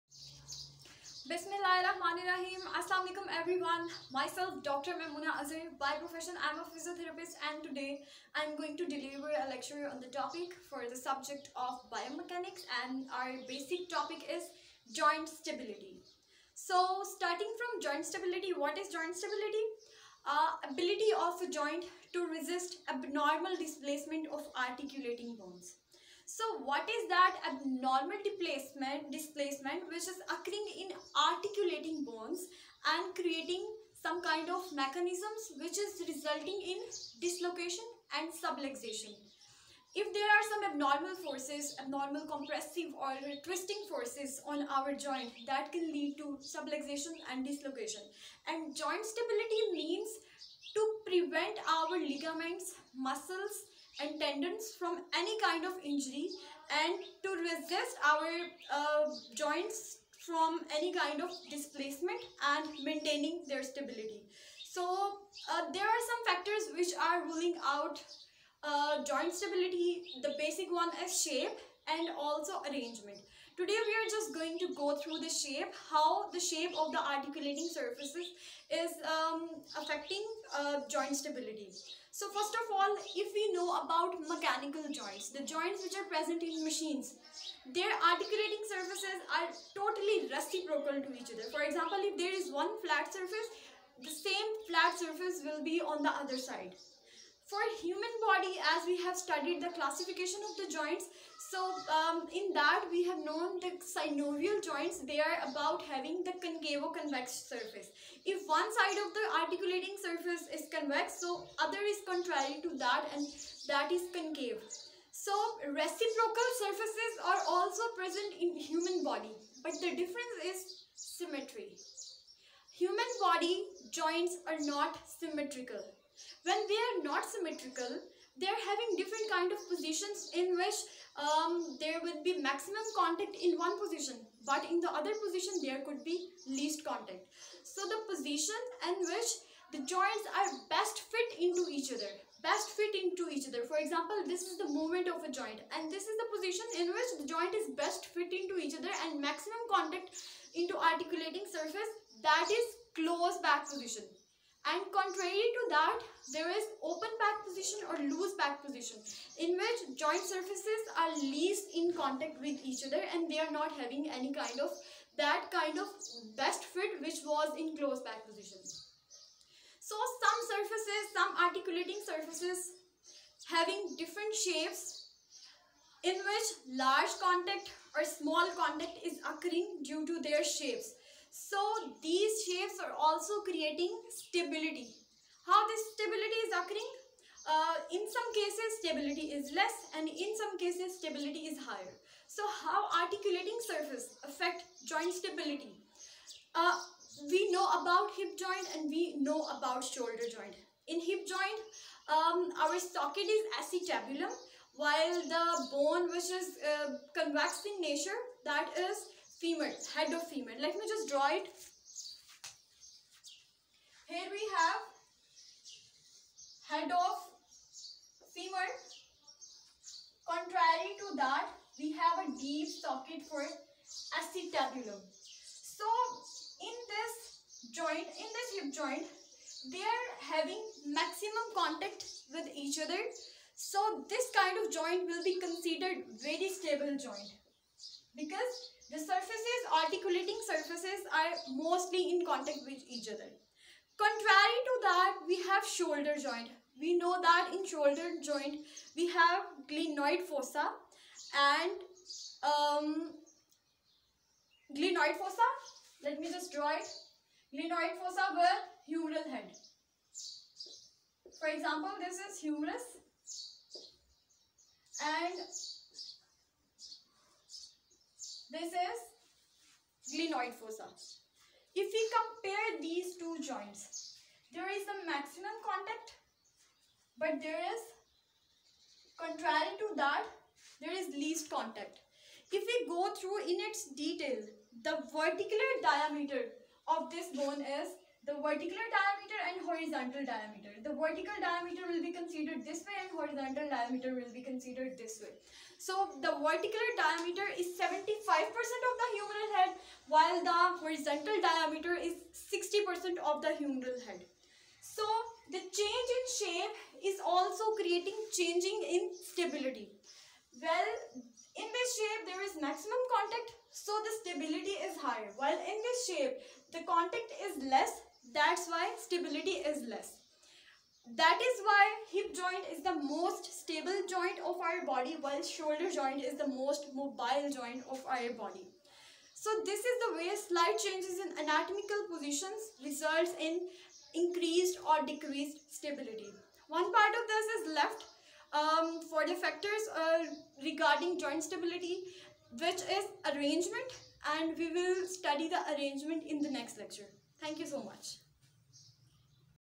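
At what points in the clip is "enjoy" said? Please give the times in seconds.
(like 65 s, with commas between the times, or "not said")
not said.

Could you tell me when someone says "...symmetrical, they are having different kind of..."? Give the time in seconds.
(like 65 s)
127 s.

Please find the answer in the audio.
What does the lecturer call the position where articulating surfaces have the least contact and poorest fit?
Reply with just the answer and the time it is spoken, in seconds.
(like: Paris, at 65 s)
Open pack position, at 156 s.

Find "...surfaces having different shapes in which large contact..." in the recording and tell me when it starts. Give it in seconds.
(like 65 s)
172 s.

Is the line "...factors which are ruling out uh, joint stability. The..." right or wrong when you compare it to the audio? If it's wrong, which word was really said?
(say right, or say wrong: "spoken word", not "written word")
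right.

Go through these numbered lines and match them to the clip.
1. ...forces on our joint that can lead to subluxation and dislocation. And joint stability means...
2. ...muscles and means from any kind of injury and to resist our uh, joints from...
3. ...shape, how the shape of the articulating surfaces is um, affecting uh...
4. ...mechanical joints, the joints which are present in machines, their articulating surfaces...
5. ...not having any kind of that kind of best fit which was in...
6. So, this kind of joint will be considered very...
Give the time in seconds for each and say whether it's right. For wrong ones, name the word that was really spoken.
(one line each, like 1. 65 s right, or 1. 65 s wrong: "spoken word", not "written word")
1. 43 s right
2. 52 s wrong: "tendons", not "means"
3. 75 s right
4. 84 s right
5. 163 s right
6. 233 s right.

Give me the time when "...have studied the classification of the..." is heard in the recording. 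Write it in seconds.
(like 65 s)
99 s.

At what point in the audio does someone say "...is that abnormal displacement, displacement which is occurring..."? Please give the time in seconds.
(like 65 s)
26 s.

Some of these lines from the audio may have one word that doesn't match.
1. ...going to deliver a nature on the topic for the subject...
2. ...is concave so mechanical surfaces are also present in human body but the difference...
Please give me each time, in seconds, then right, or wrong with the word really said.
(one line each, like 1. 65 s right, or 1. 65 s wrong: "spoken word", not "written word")
1. 8 s wrong: "lecture", not "nature"
2. 113 s wrong: "reciprocal", not "mechanical".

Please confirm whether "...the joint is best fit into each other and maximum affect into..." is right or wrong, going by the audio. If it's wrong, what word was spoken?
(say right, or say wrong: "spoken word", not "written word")
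wrong: "contact", not "affect".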